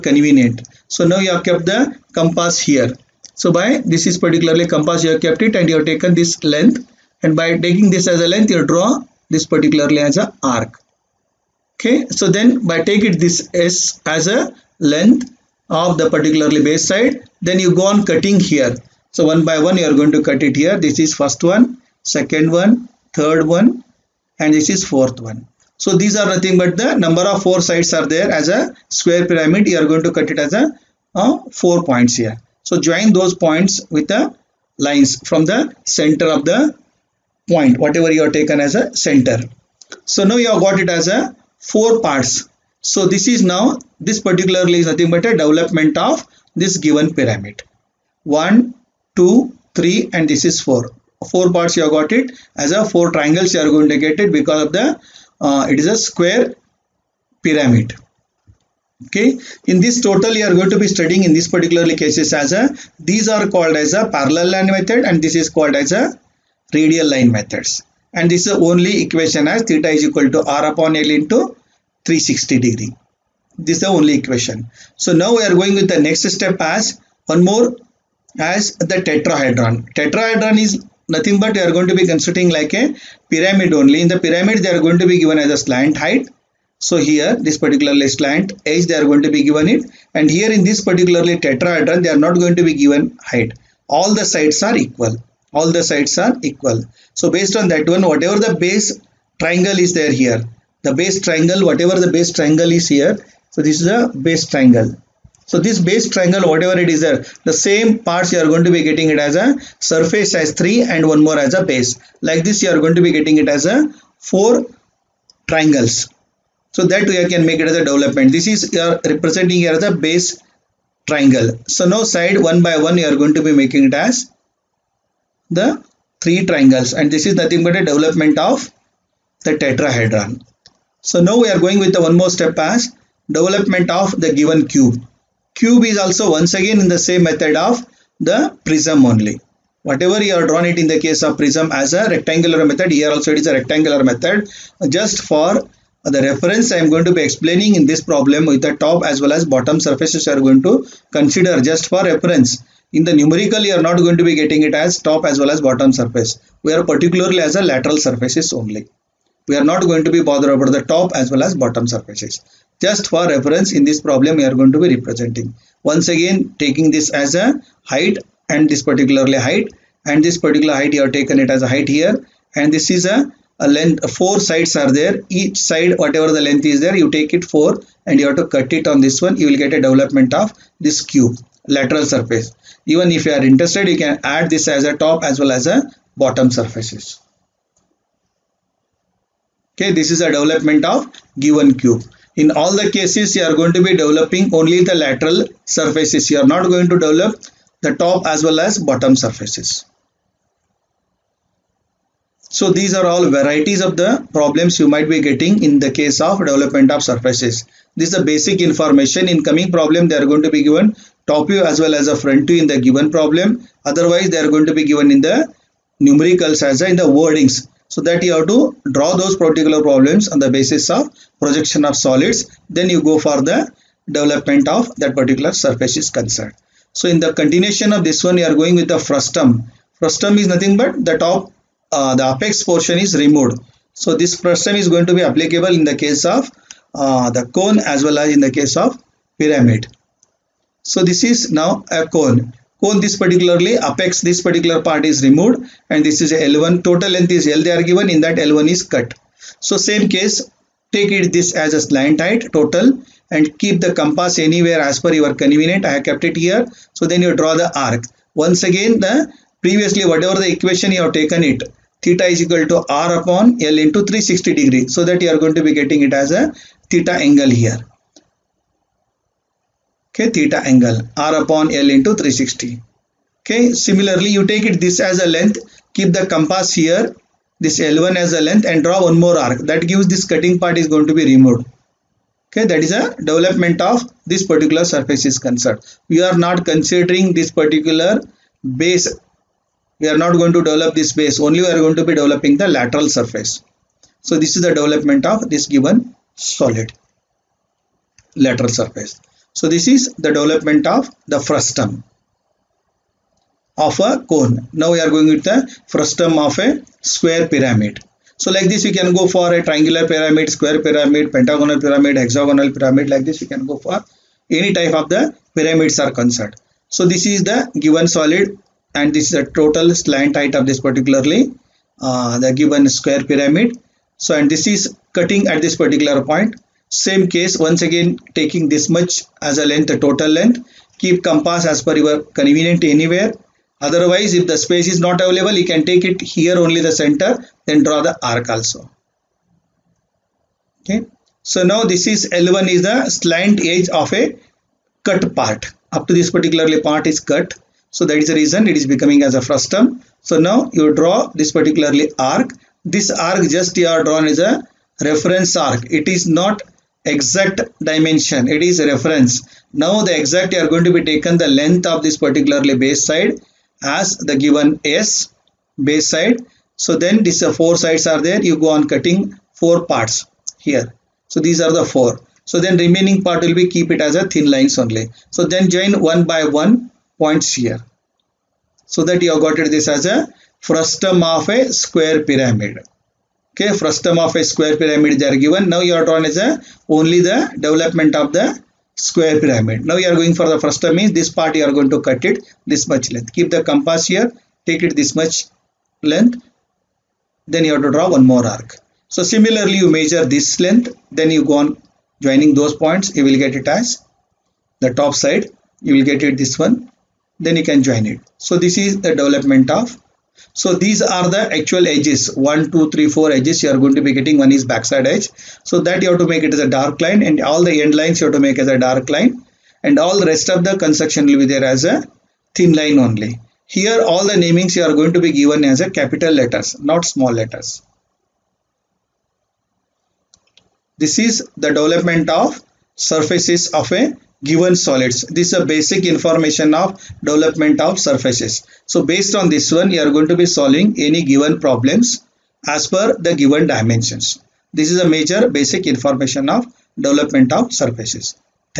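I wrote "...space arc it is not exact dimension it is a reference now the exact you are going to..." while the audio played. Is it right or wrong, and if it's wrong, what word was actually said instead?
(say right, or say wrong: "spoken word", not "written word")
wrong: "reference", not "space".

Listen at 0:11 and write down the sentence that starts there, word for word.
Okay, so then by take it this S as a length of the particularly base side then you go on cutting here.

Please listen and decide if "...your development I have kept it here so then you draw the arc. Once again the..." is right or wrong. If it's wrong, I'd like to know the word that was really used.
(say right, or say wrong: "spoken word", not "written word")
wrong: "convenient", not "development".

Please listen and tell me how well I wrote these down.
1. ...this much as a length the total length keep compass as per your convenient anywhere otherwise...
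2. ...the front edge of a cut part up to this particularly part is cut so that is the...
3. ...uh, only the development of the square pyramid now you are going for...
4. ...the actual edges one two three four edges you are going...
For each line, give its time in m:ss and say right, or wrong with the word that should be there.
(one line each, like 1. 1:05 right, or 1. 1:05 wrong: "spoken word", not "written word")
1. 5:28 right
2. 5:42 wrong: "slant", not "front"
3. 6:26 right
4. 6:51 right.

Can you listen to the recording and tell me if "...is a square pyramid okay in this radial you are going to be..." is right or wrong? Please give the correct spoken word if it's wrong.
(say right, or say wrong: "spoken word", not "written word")
wrong: "total", not "radial".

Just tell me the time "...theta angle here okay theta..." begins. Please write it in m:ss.
4:26.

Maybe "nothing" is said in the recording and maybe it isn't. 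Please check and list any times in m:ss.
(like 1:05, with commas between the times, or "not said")
0:26, 0:44, 1:21, 2:07, 3:50.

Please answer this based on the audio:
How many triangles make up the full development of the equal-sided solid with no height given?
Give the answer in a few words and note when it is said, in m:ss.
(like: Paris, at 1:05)
4, at 1:54.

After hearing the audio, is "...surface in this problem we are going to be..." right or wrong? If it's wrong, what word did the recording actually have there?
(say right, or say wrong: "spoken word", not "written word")
wrong: "reference", not "surface".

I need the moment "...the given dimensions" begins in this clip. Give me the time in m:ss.
7:23.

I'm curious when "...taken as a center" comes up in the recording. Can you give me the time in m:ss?
0:38.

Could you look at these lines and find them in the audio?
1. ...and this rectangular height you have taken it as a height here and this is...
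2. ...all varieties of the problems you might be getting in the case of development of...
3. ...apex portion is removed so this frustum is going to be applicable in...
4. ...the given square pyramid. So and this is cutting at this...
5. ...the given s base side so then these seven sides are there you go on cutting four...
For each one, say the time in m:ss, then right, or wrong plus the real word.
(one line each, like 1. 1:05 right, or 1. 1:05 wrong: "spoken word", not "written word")
1. 2:50 wrong: "particular", not "rectangular"
2. 3:23 right
3. 3:52 right
4. 5:22 right
5. 6:04 wrong: "four", not "seven".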